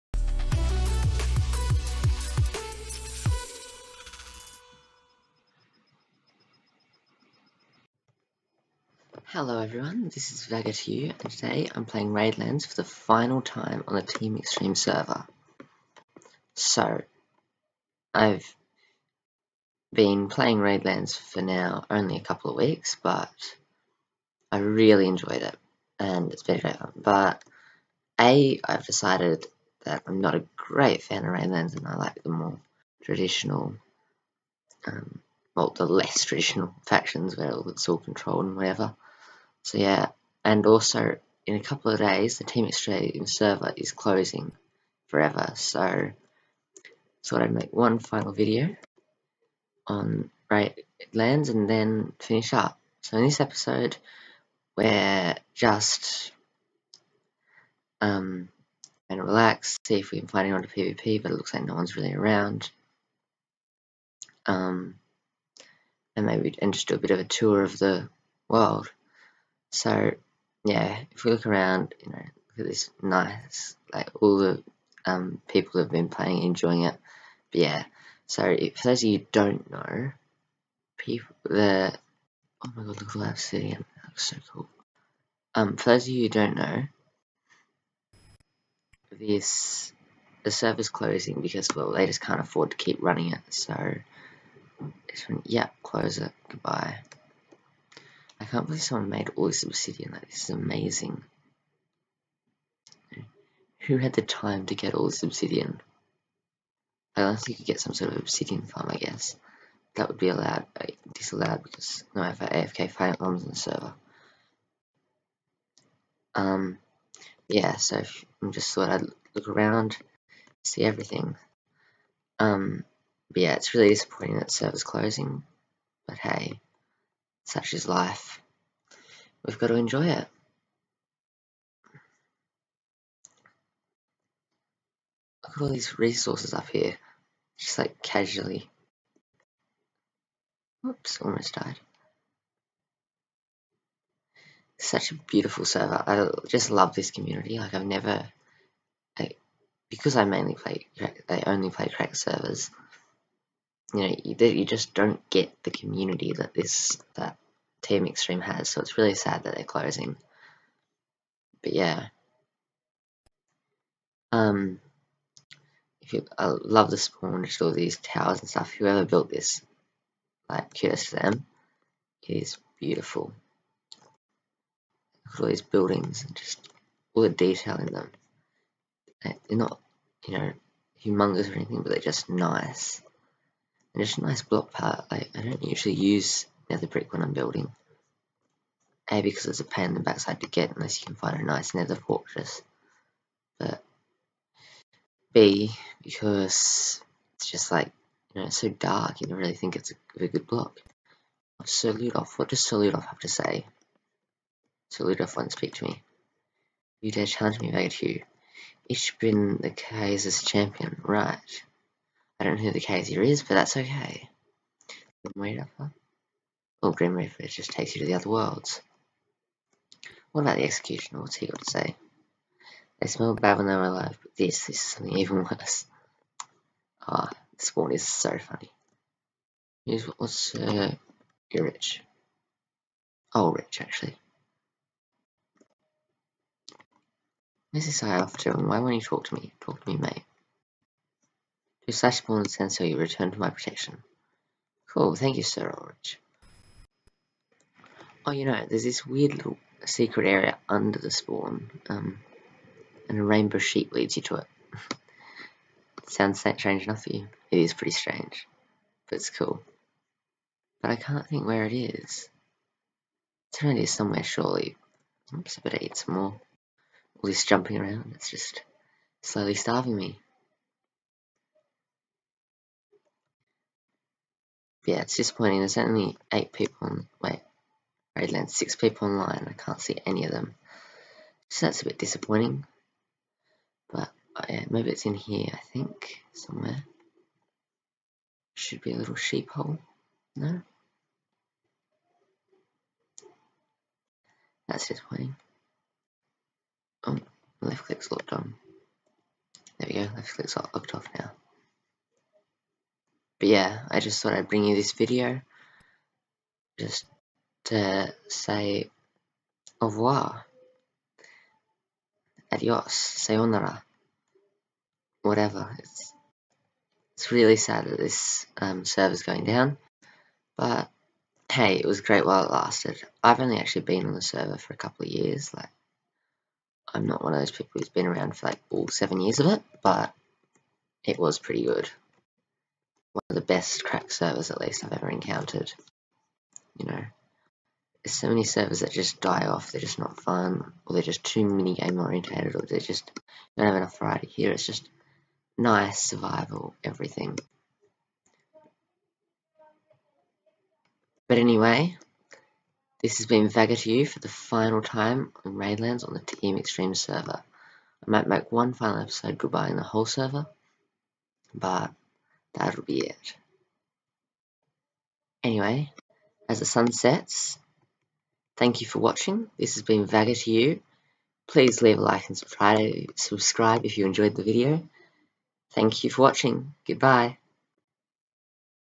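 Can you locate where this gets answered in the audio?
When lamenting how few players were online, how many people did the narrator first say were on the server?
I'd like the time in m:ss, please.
4:36.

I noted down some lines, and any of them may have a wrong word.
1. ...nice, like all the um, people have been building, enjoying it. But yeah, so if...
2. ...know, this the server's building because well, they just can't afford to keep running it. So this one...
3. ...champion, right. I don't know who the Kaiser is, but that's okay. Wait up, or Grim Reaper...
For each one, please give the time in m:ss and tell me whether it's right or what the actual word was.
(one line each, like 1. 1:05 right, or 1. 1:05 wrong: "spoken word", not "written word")
1. 1:13 wrong: "playing", not "building"
2. 1:26 wrong: "closing", not "building"
3. 3:30 right.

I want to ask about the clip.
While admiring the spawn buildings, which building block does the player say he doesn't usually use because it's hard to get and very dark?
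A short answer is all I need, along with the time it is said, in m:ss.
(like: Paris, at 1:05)
nether brick, at 3:06.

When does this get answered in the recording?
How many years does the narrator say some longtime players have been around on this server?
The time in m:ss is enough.
5:28.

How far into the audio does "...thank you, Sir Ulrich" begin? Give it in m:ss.
4:05.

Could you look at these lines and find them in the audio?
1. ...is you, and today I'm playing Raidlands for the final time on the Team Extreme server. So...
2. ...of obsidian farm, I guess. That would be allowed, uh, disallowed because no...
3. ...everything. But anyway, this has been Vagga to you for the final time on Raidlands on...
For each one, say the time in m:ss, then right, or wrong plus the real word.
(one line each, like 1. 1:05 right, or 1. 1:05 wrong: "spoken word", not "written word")
1. 0:10 right
2. 1:48 right
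3. 5:46 right.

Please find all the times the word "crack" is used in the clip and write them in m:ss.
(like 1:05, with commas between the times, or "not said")
2:31, 5:33.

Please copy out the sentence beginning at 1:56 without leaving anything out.
Um, yeah, so I'm just thought I'd look around, see everything.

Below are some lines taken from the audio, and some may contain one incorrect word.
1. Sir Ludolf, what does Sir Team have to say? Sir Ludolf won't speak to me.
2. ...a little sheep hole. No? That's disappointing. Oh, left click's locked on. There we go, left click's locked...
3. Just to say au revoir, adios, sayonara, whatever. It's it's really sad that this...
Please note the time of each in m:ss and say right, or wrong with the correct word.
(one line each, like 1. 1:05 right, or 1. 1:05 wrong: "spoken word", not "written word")
1. 3:21 wrong: "Ludolf", not "Team"
2. 4:48 right
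3. 5:06 right.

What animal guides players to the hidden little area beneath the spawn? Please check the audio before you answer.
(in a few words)
a rainbow sheep.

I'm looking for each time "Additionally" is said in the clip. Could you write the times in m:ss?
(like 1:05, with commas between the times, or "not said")
not said.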